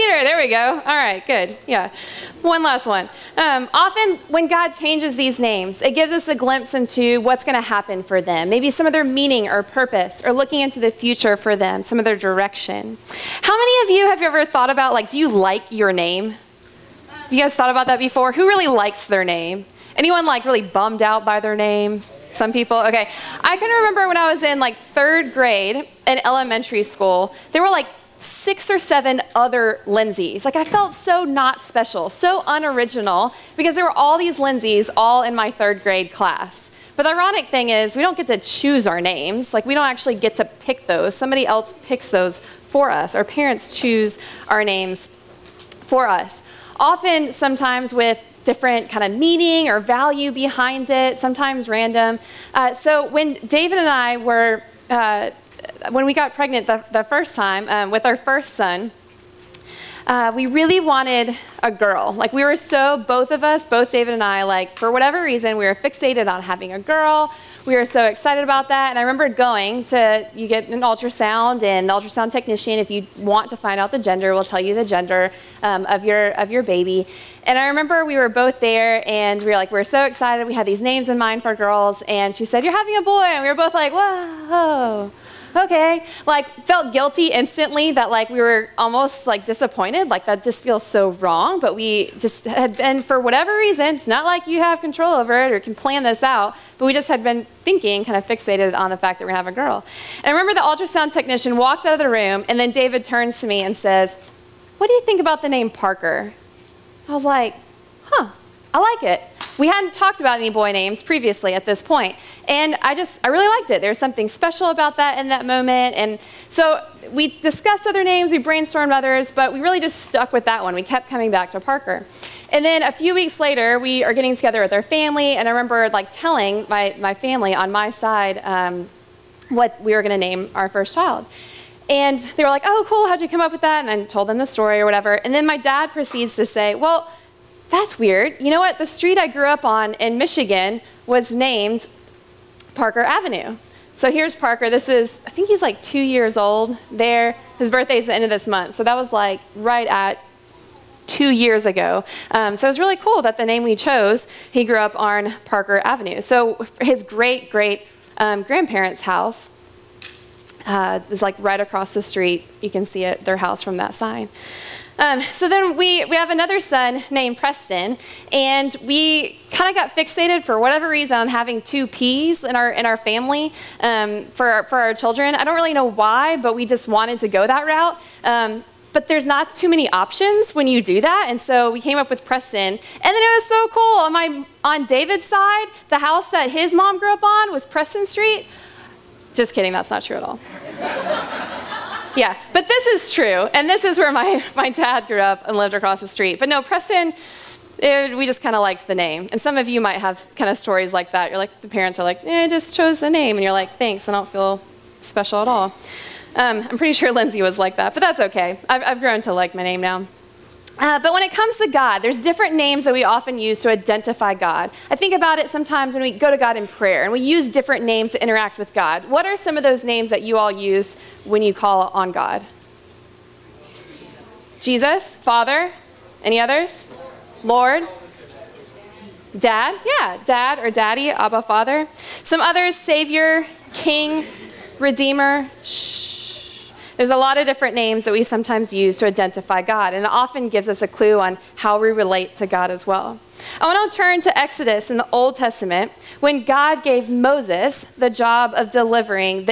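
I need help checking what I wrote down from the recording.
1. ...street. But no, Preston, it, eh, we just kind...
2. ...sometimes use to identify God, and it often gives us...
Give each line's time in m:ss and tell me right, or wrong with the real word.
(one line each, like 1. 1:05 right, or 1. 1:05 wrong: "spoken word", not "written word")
1. 3:16 right
2. 3:58 right.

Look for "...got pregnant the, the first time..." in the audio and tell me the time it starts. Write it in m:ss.
0:56.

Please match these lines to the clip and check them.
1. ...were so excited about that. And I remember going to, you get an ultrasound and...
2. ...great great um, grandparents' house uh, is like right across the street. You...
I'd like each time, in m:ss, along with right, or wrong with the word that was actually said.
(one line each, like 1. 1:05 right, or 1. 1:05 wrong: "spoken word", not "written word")
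1. 1:07 right
2. 2:37 right.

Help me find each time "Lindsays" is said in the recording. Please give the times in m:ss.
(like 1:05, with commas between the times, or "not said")
0:29, 0:34, 3:27.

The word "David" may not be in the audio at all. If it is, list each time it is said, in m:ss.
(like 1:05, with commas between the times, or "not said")
0:53, 1:03, 1:42, 3:04.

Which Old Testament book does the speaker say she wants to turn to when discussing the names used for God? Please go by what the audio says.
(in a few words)
Exodus.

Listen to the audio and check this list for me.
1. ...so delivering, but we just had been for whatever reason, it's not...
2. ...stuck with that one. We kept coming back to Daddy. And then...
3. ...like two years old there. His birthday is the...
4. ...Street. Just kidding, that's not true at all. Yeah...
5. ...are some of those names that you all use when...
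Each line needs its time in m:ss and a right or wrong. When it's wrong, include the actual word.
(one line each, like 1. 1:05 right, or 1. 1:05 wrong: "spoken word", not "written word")
1. 1:30 wrong: "wrong", not "delivering"
2. 2:00 wrong: "Parker", not "Daddy"
3. 2:25 right
4. 3:08 right
5. 3:39 right.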